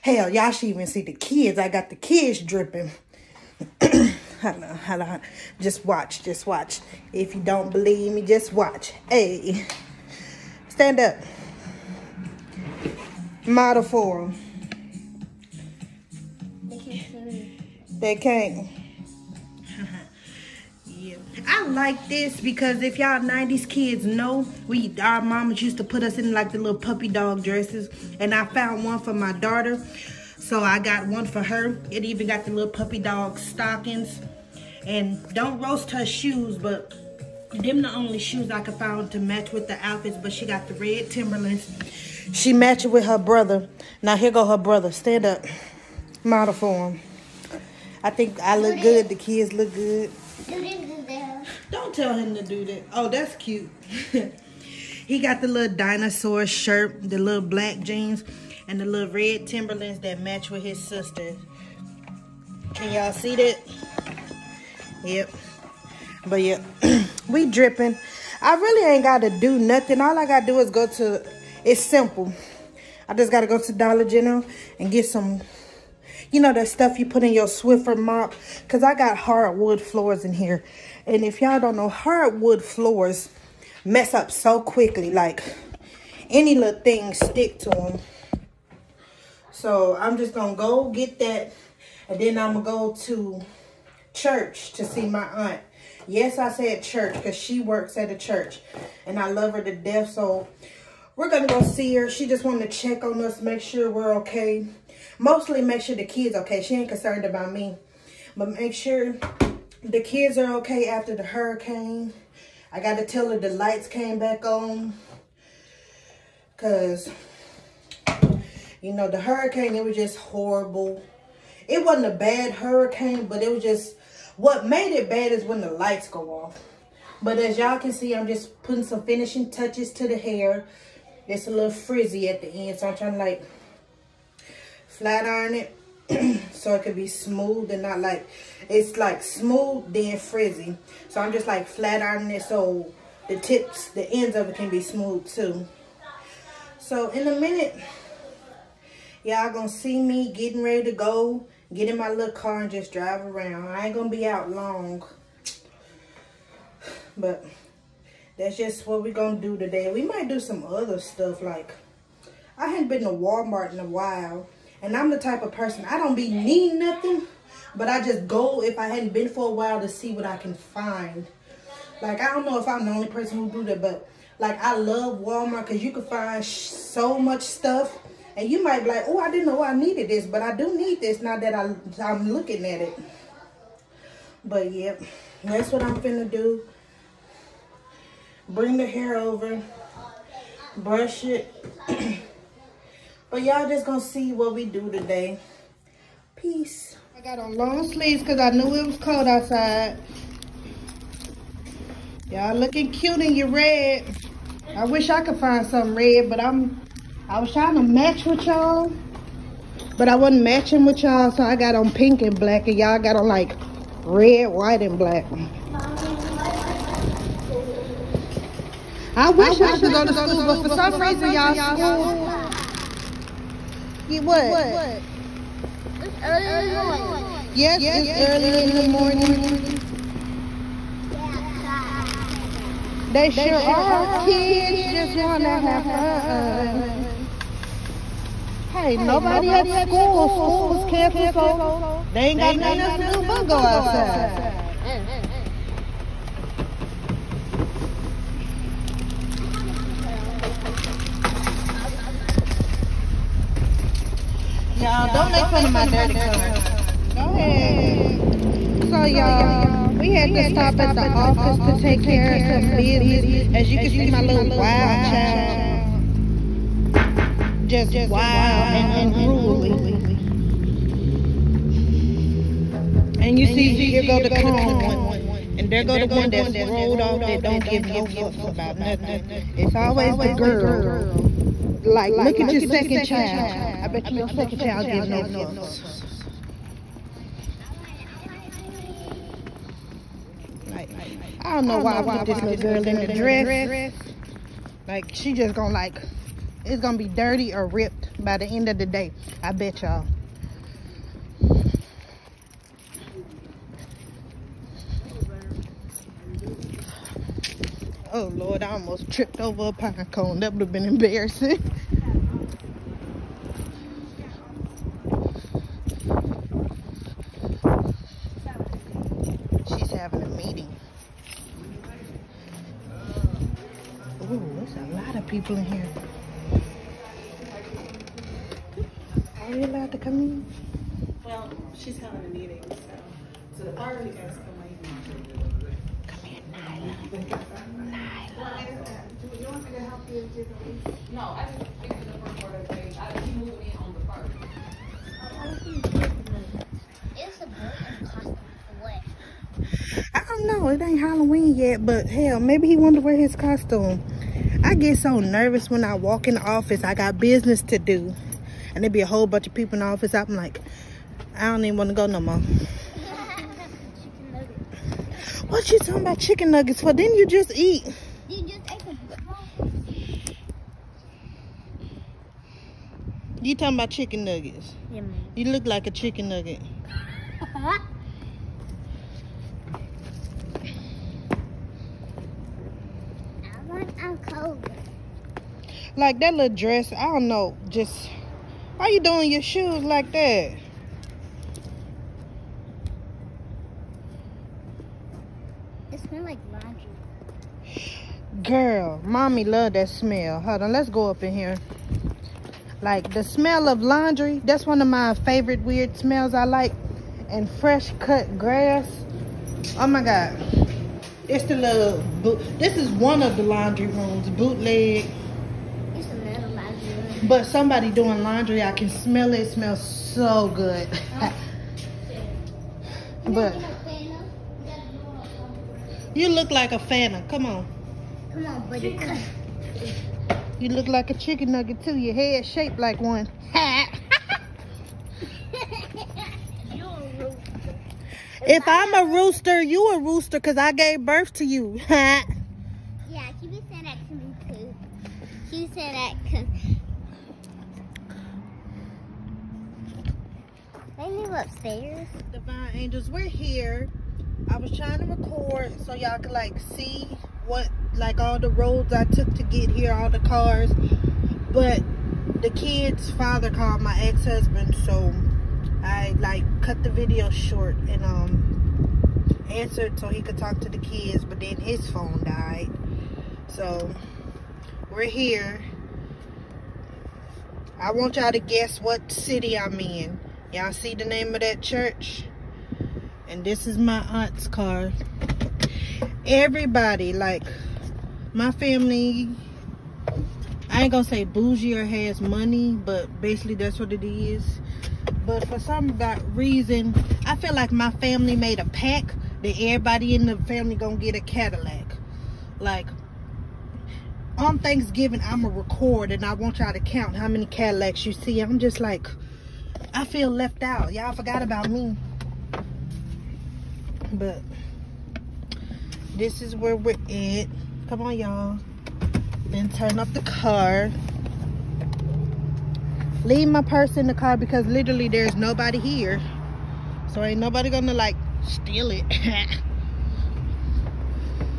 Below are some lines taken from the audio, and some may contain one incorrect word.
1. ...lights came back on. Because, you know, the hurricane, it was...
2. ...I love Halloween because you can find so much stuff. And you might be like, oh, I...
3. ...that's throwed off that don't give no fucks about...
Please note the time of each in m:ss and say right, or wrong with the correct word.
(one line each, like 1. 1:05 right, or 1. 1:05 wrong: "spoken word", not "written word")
1. 1:53 right
2. 2:54 wrong: "Walmart", not "Halloween"
3. 4:36 right.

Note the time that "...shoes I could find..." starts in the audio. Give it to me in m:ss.
0:38.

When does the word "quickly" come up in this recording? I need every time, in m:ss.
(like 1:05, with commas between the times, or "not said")
1:24.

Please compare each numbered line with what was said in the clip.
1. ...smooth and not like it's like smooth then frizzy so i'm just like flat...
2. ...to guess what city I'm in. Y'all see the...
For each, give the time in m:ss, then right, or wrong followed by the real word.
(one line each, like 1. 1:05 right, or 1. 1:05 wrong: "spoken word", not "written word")
1. 2:17 right
2. 7:58 right.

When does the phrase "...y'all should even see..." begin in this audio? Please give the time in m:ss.
0:00.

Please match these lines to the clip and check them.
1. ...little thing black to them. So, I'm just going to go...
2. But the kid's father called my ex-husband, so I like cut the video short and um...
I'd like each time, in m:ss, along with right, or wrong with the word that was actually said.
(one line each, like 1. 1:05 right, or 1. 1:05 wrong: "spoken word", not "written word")
1. 1:26 wrong: "stick", not "black"
2. 7:41 right.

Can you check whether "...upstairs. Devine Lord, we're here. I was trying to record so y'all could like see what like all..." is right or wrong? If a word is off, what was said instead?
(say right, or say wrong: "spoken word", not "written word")
wrong: "Angels", not "Lord".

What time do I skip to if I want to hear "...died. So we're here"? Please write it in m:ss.
7:52.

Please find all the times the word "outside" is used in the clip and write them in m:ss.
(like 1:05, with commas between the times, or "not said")
3:19, 4:03.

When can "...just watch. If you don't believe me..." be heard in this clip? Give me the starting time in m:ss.
0:06.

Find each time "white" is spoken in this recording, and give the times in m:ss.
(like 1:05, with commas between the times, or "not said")
3:34.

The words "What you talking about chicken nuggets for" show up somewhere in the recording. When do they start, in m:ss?
6:05.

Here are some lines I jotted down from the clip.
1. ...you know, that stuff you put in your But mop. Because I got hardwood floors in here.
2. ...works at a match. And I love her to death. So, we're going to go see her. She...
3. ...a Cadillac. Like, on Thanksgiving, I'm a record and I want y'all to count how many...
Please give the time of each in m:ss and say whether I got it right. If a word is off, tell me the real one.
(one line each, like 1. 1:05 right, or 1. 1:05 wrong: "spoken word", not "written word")
1. 1:16 wrong: "Swiffer", not "But"
2. 1:37 wrong: "church", not "match"
3. 8:21 right.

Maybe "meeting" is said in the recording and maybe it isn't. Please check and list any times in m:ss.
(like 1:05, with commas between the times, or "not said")
5:20, 5:32.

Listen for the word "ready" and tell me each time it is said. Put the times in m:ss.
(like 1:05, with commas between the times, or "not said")
2:30.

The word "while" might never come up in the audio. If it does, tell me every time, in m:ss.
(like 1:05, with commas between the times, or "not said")
2:43, 2:49.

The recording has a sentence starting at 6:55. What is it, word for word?
It's another laundry But somebody doing laundry, I can smell it.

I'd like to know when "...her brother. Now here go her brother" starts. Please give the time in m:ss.
0:43.